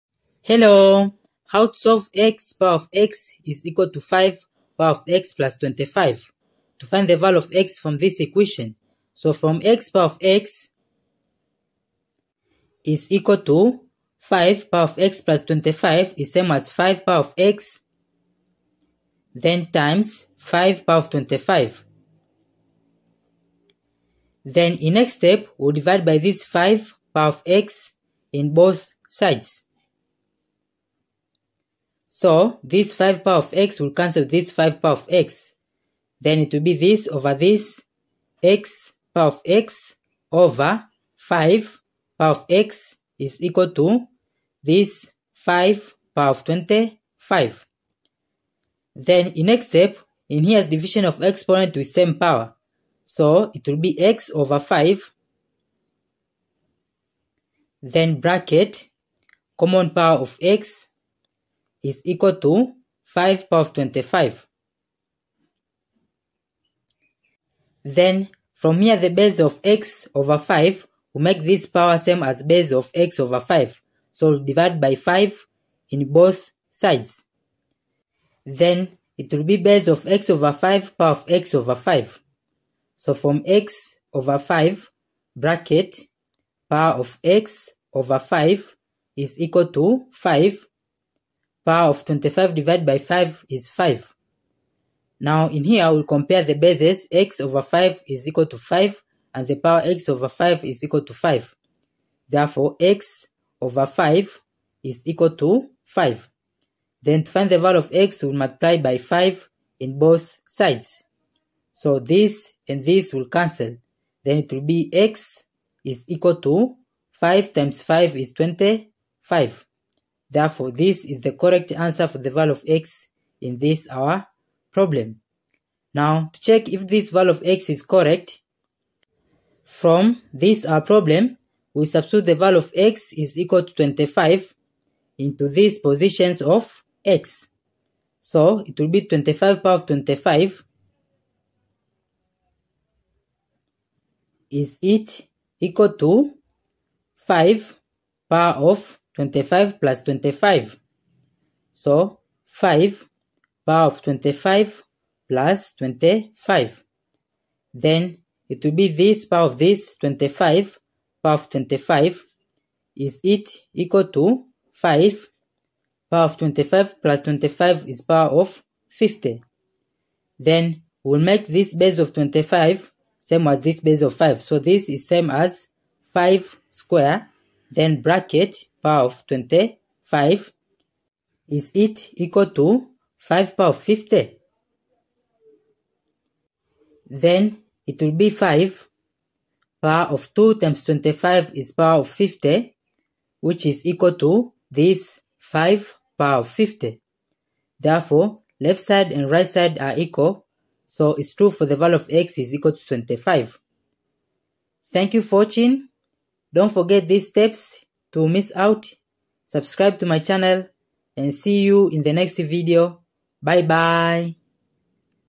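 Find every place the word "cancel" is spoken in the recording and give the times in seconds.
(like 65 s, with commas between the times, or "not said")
33 s, 113 s.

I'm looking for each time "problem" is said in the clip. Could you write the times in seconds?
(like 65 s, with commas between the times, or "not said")
124 s, 130 s.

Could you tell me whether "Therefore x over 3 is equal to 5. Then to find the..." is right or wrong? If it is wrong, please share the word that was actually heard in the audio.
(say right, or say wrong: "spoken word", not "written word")
wrong: "5", not "3".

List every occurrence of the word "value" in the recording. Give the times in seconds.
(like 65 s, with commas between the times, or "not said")
7 s, 107 s, 122 s, 127 s, 132 s, 201 s.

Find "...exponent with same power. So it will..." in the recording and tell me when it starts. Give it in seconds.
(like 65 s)
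51 s.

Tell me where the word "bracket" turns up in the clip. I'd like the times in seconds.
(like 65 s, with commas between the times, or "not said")
58 s, 85 s, 178 s.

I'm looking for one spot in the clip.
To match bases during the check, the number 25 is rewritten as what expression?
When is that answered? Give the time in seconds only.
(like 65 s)
176 s.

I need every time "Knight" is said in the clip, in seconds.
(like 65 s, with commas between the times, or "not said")
not said.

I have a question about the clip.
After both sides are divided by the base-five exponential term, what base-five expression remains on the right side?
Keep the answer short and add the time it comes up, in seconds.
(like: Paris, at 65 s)
5^25, at 44 s.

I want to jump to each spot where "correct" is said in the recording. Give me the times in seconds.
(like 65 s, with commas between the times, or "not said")
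121 s, 127 s.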